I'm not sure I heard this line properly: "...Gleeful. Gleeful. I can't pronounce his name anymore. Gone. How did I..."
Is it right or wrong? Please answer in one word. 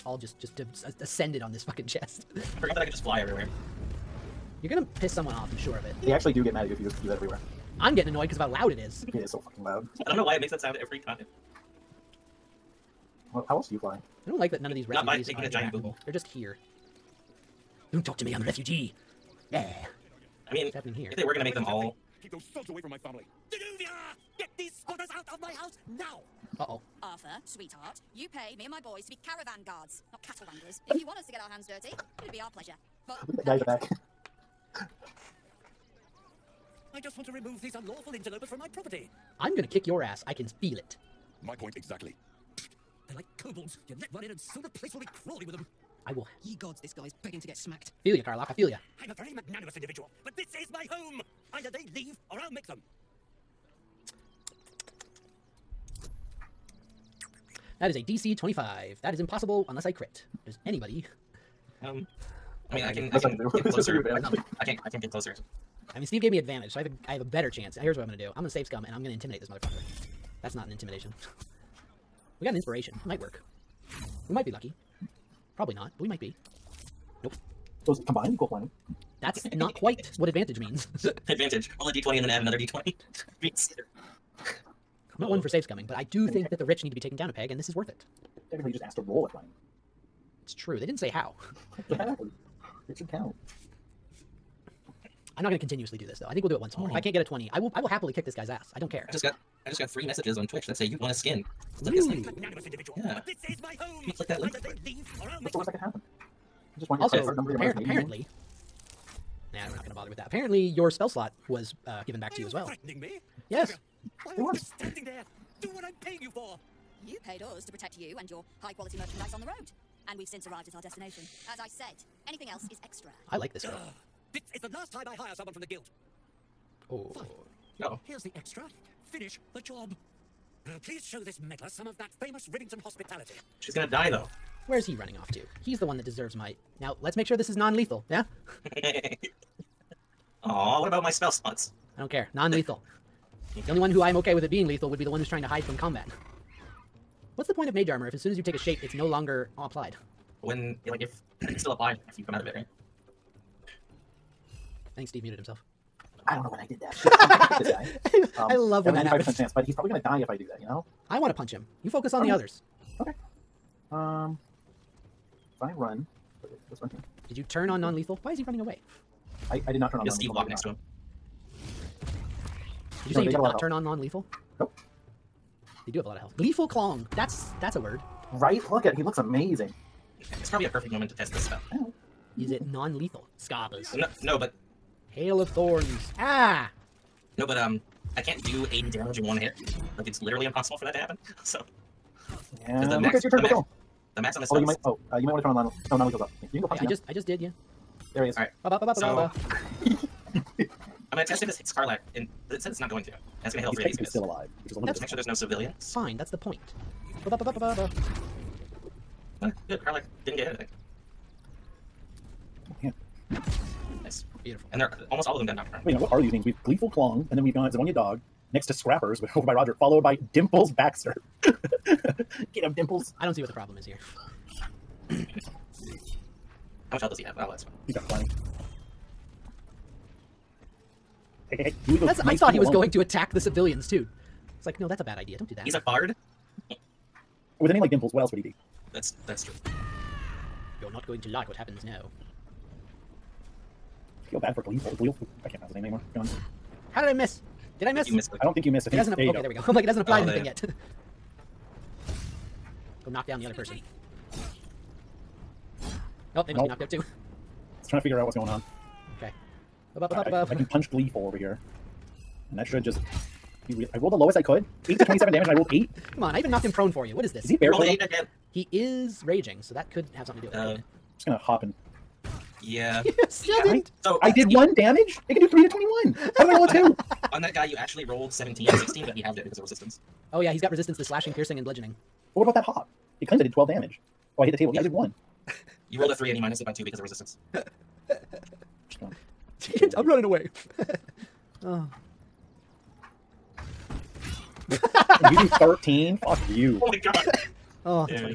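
right.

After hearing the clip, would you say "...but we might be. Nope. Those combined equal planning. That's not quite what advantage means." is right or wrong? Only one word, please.
right.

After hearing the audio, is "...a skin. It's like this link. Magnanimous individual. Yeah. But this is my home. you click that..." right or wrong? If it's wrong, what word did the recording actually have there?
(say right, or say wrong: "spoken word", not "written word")
right.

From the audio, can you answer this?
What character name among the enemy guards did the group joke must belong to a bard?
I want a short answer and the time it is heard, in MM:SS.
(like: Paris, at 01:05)
Dimples Baxter, at 03:40.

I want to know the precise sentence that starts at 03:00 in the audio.
It's probably a perfect moment to test this spell.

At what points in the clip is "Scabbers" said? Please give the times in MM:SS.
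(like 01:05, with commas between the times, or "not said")
03:03.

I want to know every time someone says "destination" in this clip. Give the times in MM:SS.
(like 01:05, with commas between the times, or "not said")
02:00.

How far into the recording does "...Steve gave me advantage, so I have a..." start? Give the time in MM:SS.
01:06.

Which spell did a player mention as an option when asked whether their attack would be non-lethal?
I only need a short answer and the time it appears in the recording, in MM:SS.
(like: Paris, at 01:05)
Hail of Thorns, at 03:05.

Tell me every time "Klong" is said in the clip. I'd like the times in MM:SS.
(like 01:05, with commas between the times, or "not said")
02:56, 03:36.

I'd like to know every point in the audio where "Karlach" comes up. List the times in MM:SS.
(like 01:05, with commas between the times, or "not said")
00:48, 03:21, 03:29.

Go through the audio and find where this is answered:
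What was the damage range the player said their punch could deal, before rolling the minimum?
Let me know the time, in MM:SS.
04:24.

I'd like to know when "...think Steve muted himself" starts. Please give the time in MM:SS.
02:34.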